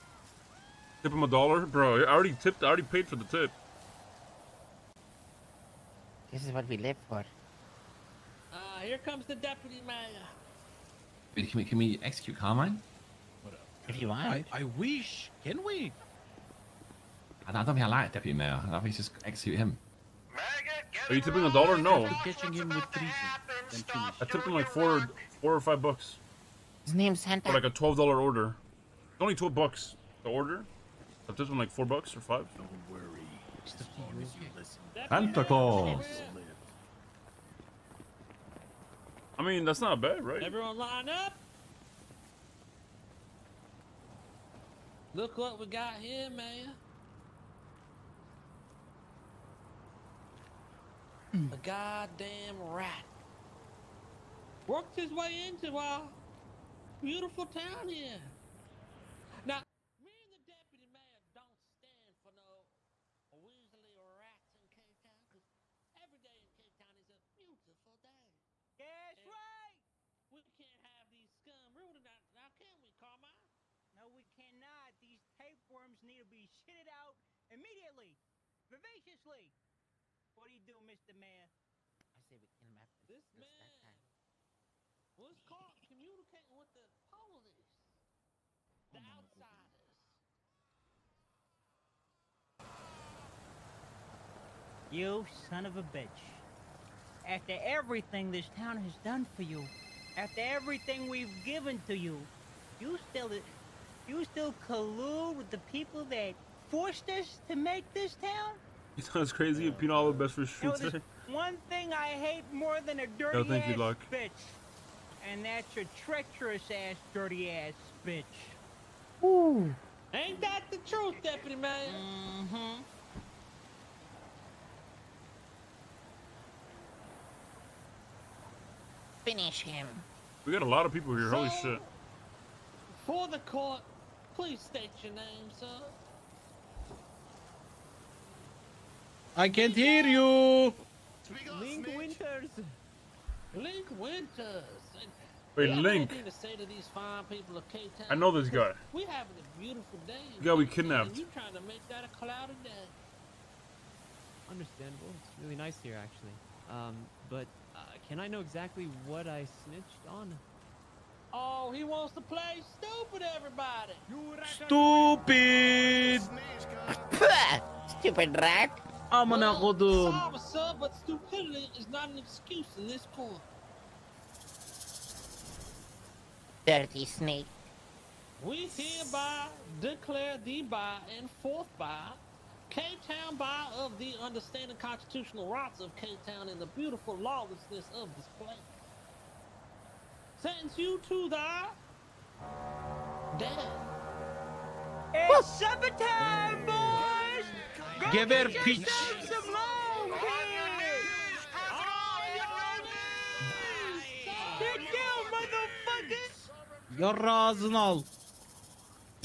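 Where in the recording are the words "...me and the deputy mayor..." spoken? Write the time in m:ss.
0:59.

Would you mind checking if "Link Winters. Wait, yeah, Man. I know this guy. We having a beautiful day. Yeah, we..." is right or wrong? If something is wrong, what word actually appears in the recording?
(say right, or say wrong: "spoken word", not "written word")
wrong: "Link", not "Man".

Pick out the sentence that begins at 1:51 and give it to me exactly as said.
one thing I hate more than a dirty no, thank you, Luck.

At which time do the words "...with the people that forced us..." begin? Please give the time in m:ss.
1:45.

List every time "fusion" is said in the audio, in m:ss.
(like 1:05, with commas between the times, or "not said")
not said.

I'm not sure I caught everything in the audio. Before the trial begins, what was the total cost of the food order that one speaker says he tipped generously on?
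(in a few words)
$12.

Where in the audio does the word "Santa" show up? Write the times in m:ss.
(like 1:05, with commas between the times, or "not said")
0:27, 0:35.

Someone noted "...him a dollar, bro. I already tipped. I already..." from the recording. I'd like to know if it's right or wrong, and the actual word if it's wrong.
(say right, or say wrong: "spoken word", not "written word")
right.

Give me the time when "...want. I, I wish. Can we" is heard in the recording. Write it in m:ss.
0:14.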